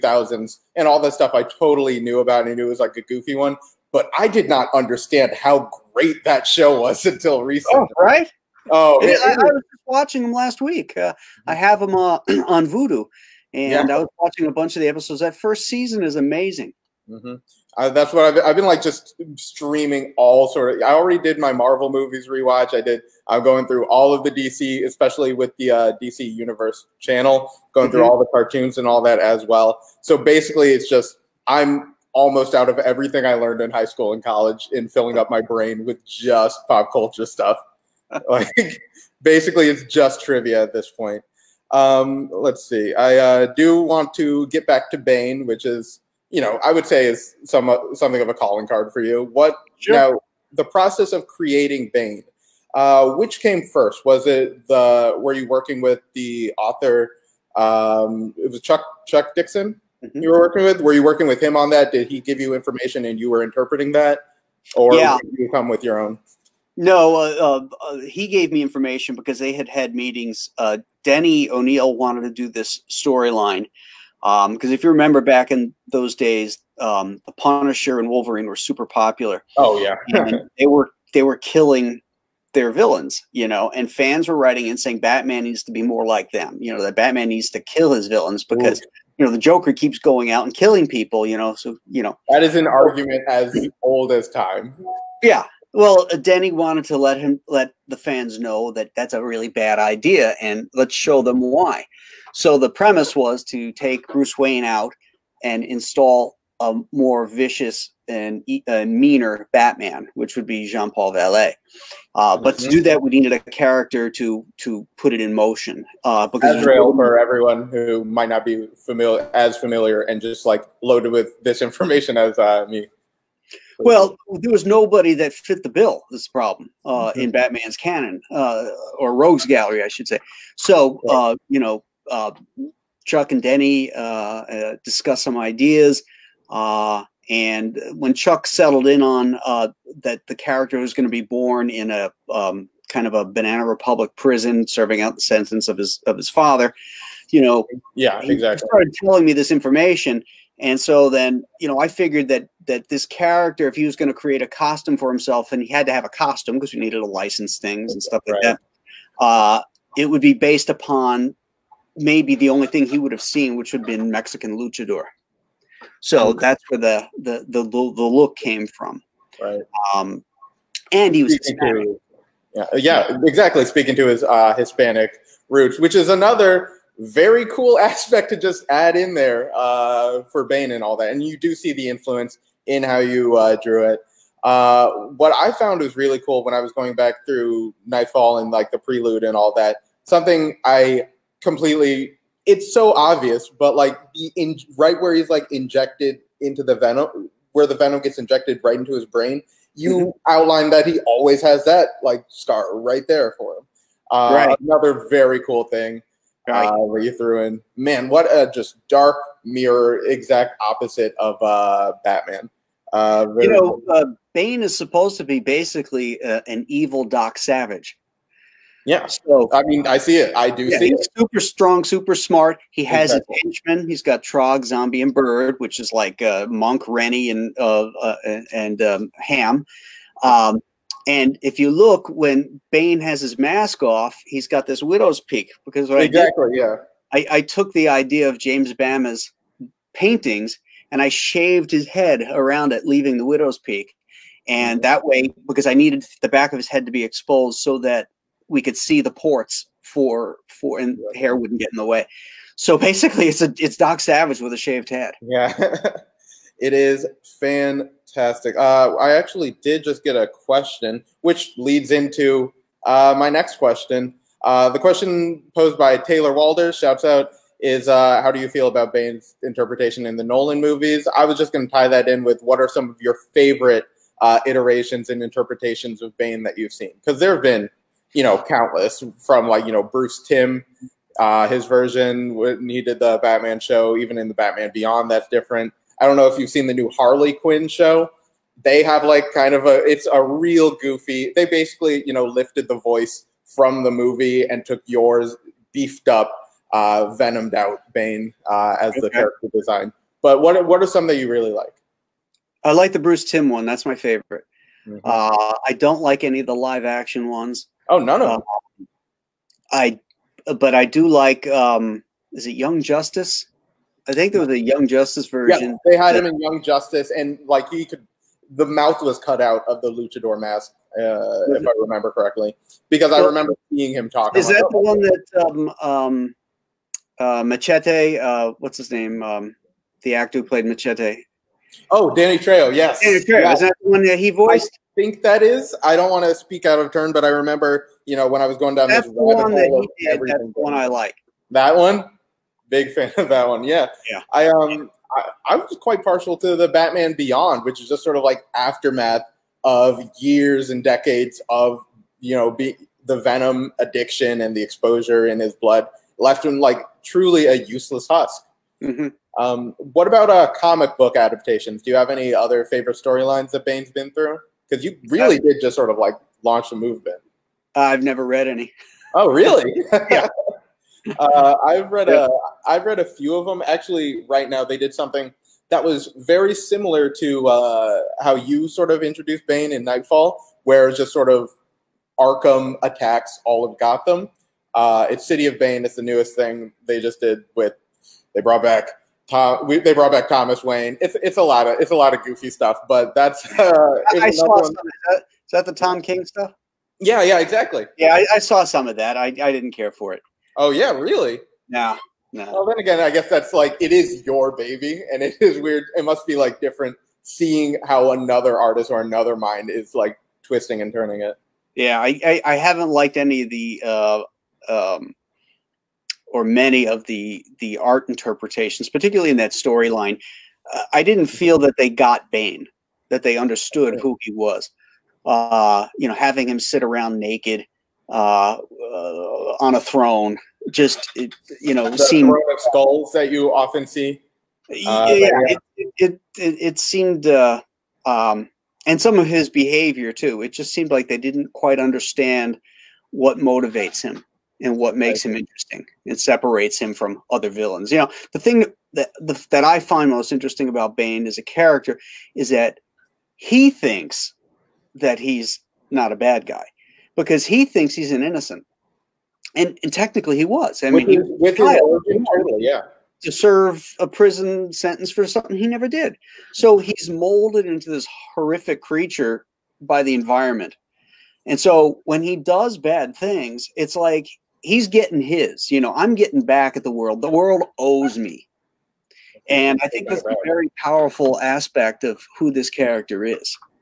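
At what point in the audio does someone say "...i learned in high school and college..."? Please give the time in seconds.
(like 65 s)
33 s.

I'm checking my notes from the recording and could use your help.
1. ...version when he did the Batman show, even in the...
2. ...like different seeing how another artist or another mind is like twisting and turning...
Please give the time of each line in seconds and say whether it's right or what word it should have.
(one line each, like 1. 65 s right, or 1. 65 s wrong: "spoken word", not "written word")
1. 281 s right
2. 406 s right.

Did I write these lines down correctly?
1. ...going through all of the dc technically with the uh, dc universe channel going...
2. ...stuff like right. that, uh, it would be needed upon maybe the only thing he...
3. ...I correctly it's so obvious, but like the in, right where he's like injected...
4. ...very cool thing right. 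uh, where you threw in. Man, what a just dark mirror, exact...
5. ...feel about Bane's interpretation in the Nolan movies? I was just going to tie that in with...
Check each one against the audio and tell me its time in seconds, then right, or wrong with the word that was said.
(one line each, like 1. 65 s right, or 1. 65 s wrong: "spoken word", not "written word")
1. 23 s wrong: "especially", not "technically"
2. 158 s wrong: "based", not "needed"
3. 190 s wrong: "completely", not "correctly"
4. 205 s right
5. 268 s right.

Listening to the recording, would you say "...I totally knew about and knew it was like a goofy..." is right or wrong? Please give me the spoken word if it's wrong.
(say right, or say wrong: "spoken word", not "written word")
right.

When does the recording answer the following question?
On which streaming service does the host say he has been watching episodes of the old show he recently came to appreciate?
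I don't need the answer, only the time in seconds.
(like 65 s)
12 s.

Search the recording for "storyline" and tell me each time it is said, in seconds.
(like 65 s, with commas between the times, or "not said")
72 s, 362 s, 419 s.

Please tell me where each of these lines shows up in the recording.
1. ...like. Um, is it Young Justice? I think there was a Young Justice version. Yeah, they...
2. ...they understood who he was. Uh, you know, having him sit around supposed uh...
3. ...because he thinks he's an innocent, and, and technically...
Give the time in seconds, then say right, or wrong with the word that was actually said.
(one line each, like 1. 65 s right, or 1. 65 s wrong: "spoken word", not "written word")
1. 311 s right
2. 423 s wrong: "naked", not "supposed"
3. 457 s right.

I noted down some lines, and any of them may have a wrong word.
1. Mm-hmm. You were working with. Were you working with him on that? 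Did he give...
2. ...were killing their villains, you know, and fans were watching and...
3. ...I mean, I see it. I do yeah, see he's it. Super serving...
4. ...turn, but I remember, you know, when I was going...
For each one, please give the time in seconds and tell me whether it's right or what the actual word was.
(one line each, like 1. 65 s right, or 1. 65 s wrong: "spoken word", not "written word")
1. 60 s right
2. 81 s wrong: "writing", not "watching"
3. 219 s wrong: "strong", not "serving"
4. 336 s right.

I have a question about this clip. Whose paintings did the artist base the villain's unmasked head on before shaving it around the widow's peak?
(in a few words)
James Bama.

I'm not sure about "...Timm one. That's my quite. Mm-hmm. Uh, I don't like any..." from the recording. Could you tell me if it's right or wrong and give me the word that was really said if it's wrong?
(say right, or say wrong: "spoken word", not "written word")
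wrong: "favorite", not "quite".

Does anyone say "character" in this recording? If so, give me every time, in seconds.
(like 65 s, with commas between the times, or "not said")
113 s, 140 s, 153 s, 299 s, 451 s, 482 s.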